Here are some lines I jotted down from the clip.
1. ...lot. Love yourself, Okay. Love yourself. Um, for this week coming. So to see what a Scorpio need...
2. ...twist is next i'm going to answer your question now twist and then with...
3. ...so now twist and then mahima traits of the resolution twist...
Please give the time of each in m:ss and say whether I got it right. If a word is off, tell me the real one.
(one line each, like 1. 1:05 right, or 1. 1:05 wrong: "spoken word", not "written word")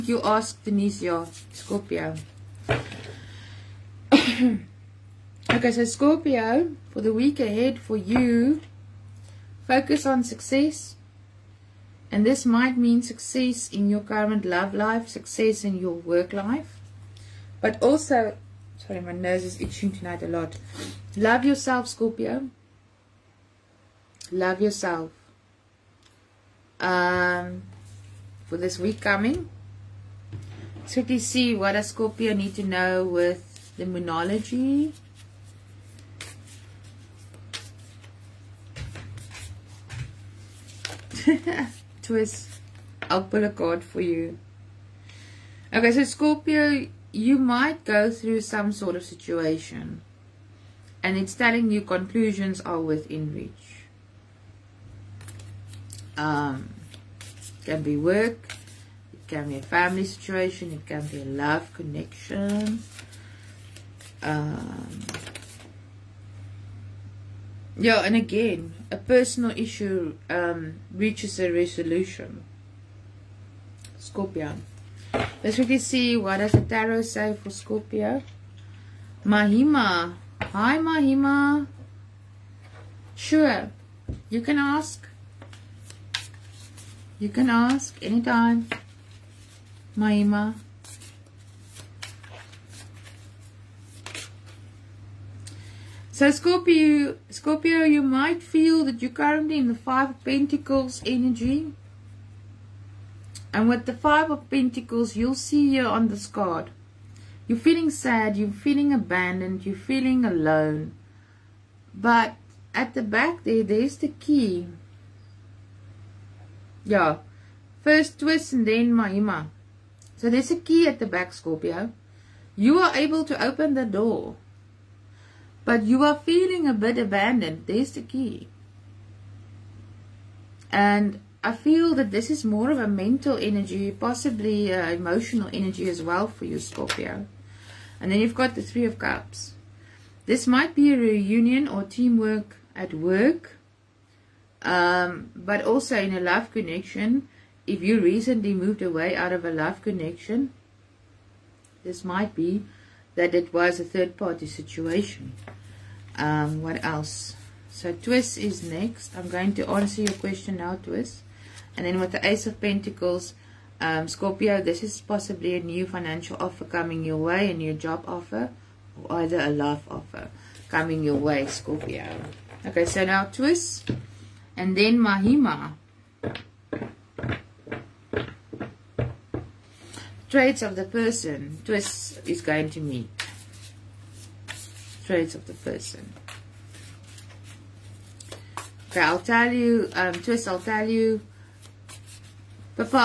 1. 0:20 wrong: "Scorpio", not "Okay"
2. 2:37 right
3. 2:52 wrong: "person", not "resolution".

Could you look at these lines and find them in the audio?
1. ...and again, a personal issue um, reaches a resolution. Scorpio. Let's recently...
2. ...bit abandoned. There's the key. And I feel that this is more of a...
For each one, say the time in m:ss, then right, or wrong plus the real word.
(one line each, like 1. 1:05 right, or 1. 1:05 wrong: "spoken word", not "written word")
1. 1:08 wrong: "quickly", not "recently"
2. 2:06 right.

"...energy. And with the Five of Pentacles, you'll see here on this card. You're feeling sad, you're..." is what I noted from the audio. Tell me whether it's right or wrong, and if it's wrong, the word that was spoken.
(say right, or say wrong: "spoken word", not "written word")
right.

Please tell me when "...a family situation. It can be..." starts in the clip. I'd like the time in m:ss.
0:59.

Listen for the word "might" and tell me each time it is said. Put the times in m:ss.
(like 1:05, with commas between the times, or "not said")
0:12, 0:47, 1:38, 2:20, 2:32.